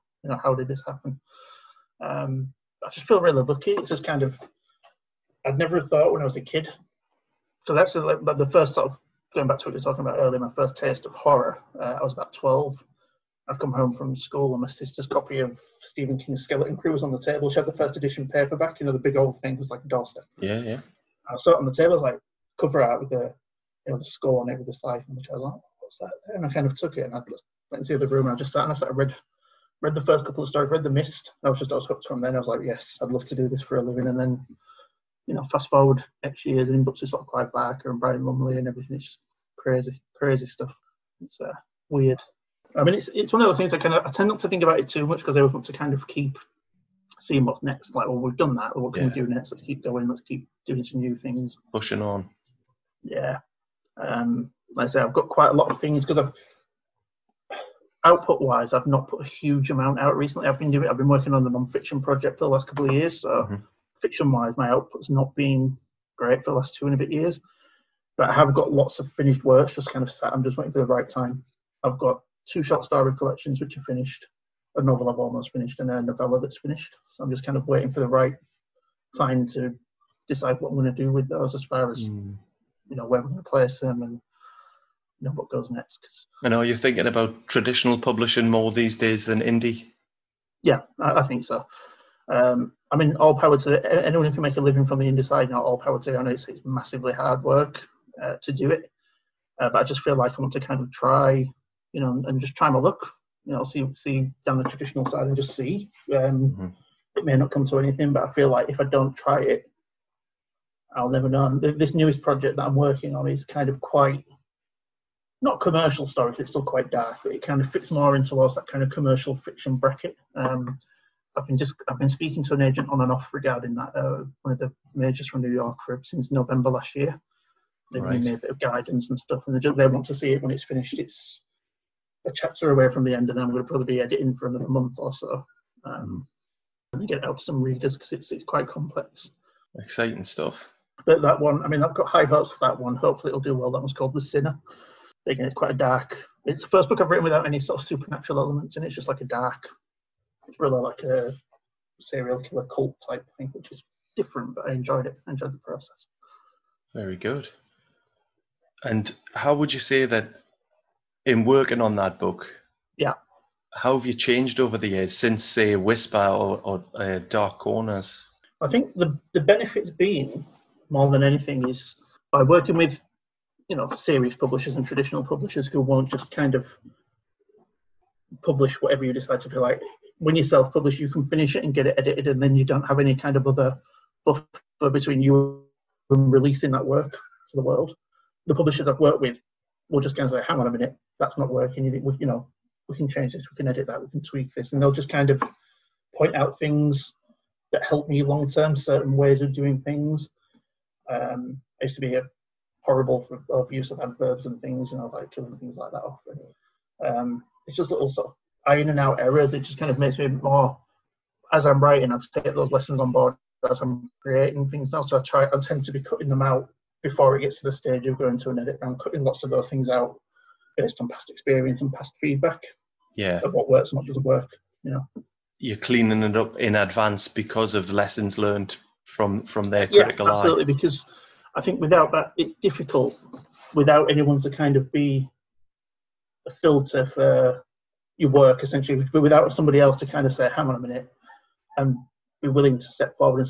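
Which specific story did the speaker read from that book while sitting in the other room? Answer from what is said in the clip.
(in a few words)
The Mist.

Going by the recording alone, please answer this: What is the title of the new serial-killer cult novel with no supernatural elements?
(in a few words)
The Sinner.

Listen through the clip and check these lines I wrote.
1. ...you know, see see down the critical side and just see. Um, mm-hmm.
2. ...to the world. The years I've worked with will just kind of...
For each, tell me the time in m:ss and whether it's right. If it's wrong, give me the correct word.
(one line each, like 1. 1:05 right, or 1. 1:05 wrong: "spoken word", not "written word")
1. 1:43 wrong: "traditional", not "critical"
2. 3:07 wrong: "publishers", not "years".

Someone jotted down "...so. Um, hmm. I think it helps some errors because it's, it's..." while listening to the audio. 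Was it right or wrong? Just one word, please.
wrong.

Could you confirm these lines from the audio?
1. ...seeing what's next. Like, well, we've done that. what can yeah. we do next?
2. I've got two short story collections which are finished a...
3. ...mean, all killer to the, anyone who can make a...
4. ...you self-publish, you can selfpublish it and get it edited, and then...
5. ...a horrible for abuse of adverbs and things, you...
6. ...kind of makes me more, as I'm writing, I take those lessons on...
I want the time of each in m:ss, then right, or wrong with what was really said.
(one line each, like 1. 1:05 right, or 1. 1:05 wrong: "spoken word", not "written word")
1. 0:47 right
2. 1:11 right
3. 1:32 wrong: "power", not "killer"
4. 3:00 wrong: "finish", not "selfpublish"
5. 3:22 right
6. 3:29 right.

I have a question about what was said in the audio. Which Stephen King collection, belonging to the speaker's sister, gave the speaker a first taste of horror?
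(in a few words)
Skeleton Crew.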